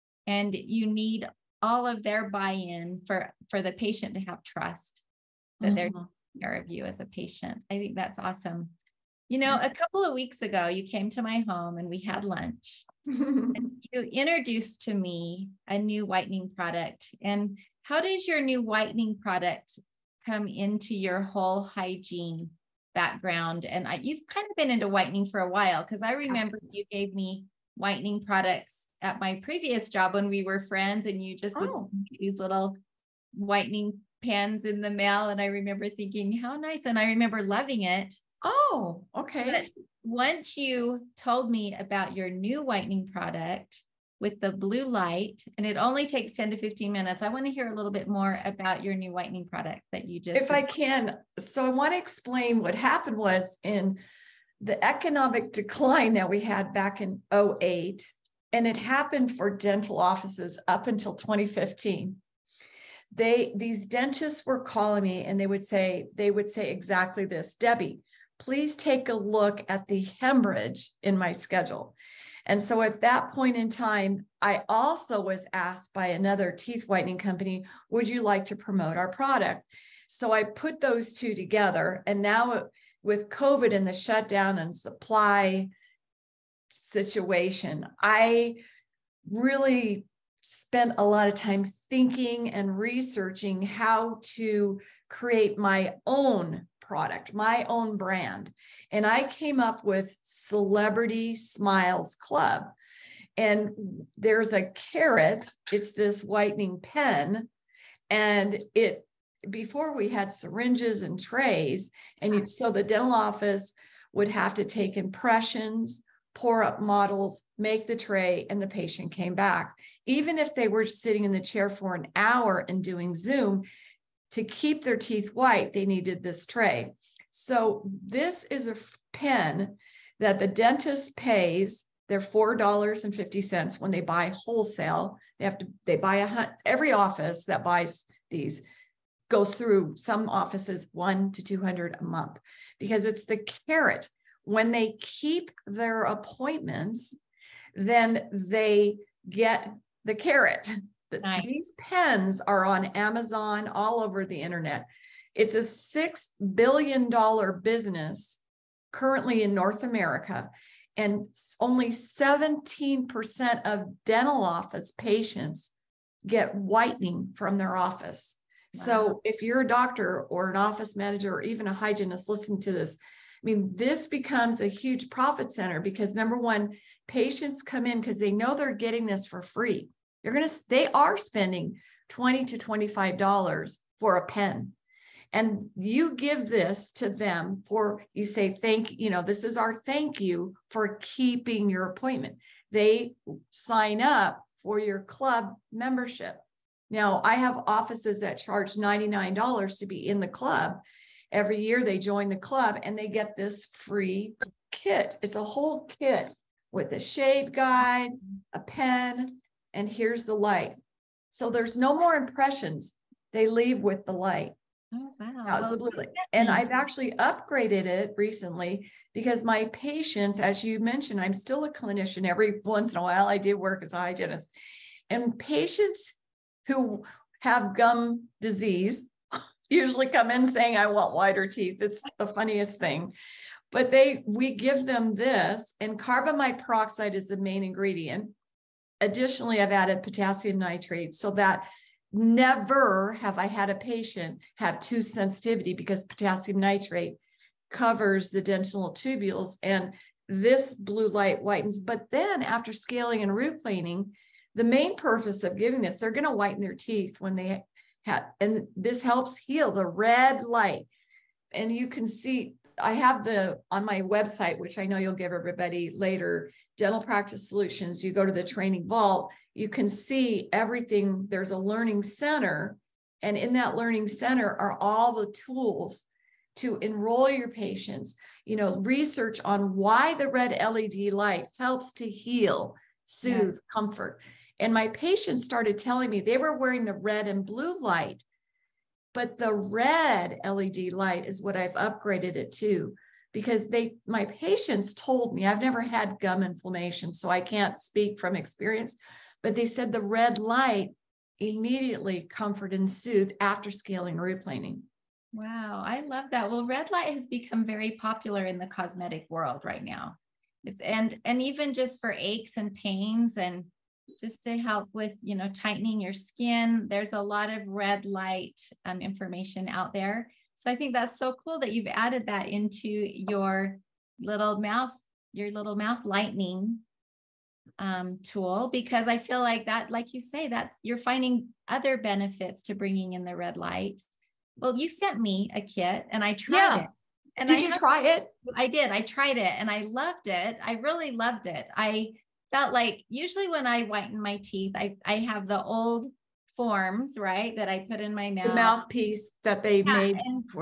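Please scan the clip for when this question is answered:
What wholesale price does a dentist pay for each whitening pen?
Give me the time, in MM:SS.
02:12.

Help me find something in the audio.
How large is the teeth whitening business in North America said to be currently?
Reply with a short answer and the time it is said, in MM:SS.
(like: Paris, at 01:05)
$6 billion, at 02:35.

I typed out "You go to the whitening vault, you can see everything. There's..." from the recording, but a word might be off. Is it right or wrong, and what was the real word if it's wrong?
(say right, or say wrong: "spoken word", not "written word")
wrong: "training", not "whitening".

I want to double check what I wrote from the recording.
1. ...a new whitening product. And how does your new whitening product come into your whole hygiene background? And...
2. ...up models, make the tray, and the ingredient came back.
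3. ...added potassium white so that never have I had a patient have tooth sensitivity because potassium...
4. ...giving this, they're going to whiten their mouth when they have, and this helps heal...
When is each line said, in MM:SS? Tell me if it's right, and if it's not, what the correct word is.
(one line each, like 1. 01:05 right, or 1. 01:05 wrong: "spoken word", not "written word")
1. 00:15 right
2. 01:56 wrong: "patient", not "ingredient"
3. 03:59 wrong: "nitrate", not "white"
4. 04:15 wrong: "teeth", not "mouth".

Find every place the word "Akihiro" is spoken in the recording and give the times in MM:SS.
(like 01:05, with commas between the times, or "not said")
not said.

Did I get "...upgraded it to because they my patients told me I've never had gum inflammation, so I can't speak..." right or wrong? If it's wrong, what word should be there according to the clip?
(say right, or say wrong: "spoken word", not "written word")
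right.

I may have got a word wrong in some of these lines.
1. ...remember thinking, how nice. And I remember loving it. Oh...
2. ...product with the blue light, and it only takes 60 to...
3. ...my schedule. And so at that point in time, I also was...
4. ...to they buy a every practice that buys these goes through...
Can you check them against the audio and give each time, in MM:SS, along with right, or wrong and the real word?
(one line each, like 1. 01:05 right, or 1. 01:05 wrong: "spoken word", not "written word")
1. 00:35 right
2. 00:43 wrong: "10", not "60"
3. 01:11 right
4. 02:15 wrong: "office", not "practice".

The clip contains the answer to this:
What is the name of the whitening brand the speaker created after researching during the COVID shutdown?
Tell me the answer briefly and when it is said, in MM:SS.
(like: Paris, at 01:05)
Celebrity Smiles Club, at 01:40.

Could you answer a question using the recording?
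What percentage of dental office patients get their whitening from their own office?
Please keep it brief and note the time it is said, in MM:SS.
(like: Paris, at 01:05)
17%, at 02:41.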